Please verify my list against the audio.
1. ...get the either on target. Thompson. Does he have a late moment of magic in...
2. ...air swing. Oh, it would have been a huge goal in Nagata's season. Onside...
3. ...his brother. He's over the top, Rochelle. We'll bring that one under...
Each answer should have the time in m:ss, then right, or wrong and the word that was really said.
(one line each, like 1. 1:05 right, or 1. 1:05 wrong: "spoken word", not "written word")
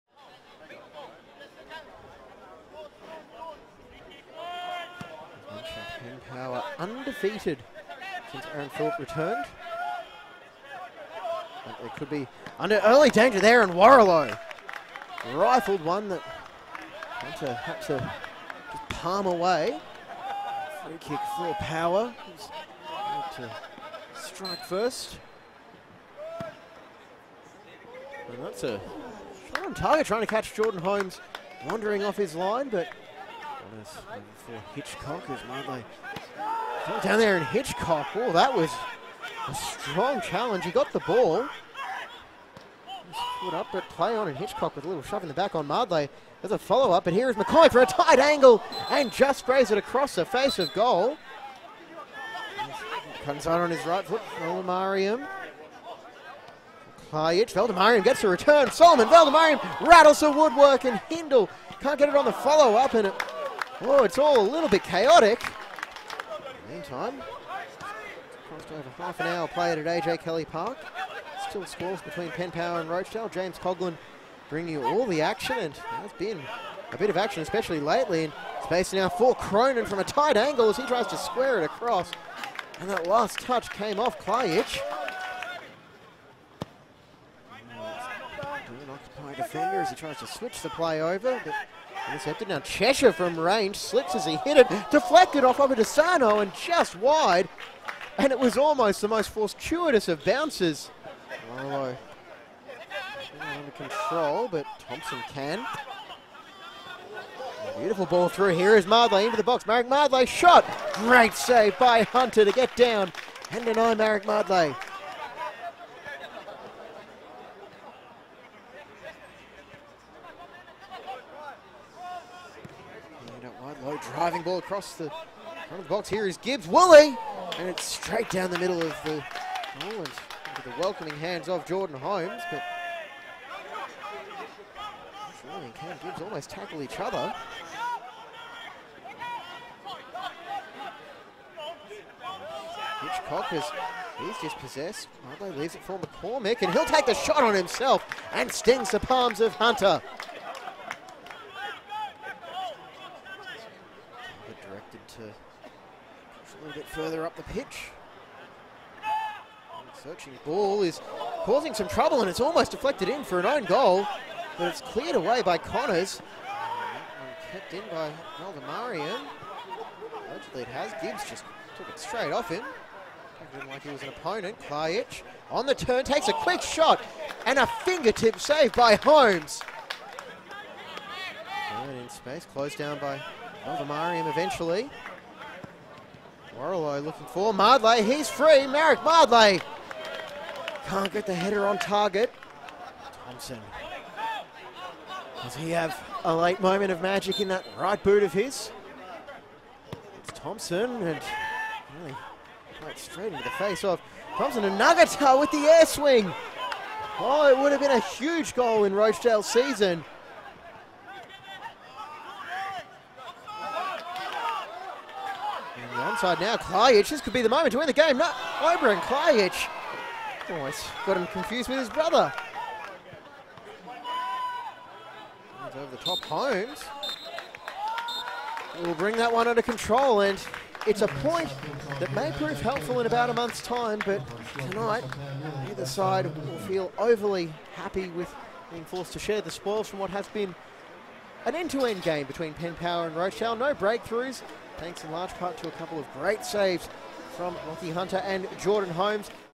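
1. 3:11 wrong: "header", not "either"
2. 3:25 wrong: "Rochedale", not "Nagata"
3. 3:41 wrong: "Holmes", not "Rochelle".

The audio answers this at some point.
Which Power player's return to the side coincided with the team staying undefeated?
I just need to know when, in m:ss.
0:08.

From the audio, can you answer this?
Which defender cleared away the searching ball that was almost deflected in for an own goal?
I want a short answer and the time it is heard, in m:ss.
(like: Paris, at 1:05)
Connors, at 2:45.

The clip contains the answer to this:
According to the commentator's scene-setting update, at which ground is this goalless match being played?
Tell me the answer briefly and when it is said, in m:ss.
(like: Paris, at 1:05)
AJ Kelly Park, at 1:09.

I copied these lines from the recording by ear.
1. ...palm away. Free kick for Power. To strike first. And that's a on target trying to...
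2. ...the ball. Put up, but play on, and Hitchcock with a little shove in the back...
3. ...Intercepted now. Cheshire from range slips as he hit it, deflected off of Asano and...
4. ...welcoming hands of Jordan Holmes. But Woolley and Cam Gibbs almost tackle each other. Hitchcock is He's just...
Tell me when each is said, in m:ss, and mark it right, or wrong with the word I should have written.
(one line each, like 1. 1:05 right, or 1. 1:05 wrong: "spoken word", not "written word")
1. 0:18 right
2. 0:40 right
3. 1:32 right
4. 2:10 right.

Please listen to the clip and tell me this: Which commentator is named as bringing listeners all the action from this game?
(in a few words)
James Coglin.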